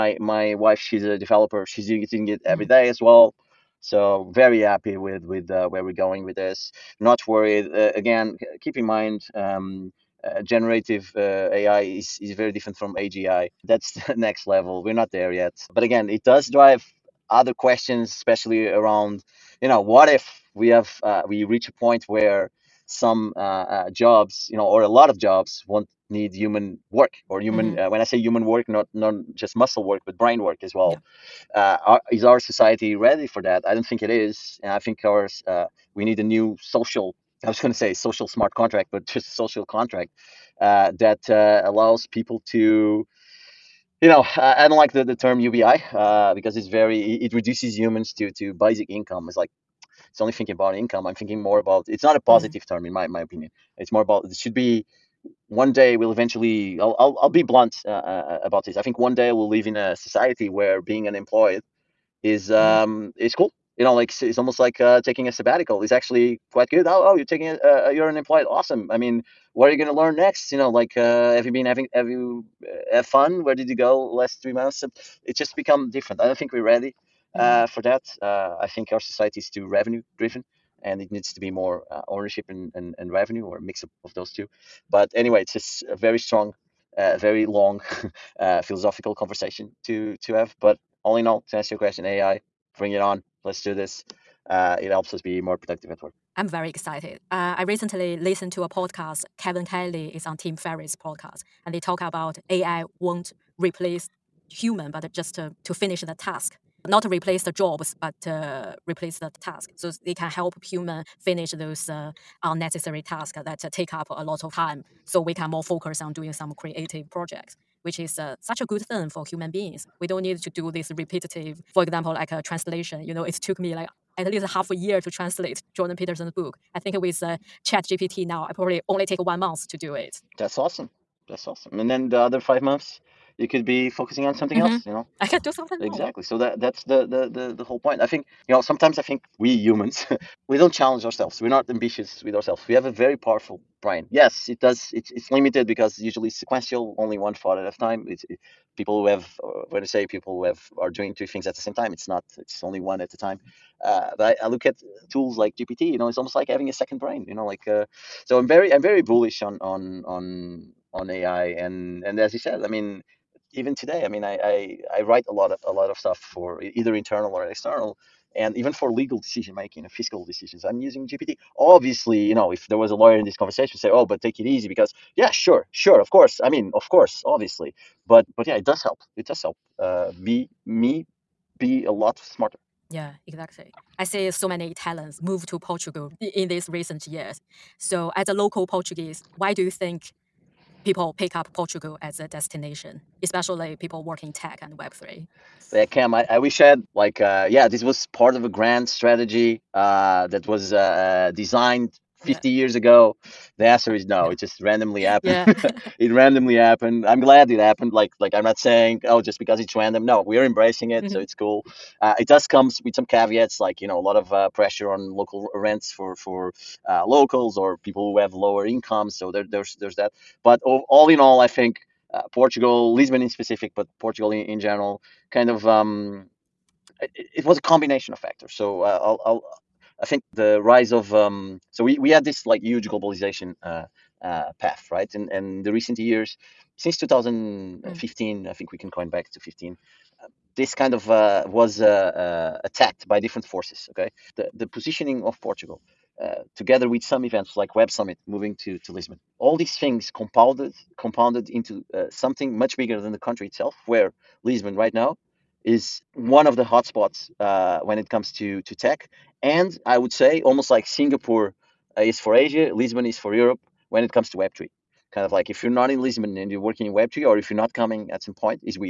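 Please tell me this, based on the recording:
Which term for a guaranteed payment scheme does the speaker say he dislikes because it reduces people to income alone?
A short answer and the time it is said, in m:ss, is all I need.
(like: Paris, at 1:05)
UBI, at 0:45.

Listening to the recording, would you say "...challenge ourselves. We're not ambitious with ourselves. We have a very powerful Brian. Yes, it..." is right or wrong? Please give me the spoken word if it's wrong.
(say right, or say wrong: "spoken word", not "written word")
right.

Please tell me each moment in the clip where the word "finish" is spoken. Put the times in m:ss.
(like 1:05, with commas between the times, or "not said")
1:45, 1:51.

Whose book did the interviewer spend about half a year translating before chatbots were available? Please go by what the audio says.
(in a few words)
Jordan Peterson.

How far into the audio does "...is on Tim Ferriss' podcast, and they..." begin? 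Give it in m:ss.
1:40.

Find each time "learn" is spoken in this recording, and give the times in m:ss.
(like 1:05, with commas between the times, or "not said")
1:09.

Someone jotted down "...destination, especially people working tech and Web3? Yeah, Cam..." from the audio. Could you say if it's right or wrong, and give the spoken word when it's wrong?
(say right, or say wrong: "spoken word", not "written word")
right.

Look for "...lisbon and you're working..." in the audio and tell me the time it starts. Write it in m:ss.
4:26.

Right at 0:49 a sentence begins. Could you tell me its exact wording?
It's like it's only thinking about income.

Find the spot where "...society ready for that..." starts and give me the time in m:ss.
0:32.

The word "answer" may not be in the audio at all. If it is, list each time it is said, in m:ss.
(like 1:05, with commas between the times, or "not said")
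1:31, 3:23.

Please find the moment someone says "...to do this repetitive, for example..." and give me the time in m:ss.
2:00.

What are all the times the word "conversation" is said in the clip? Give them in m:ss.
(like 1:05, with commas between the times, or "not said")
1:29, 2:53.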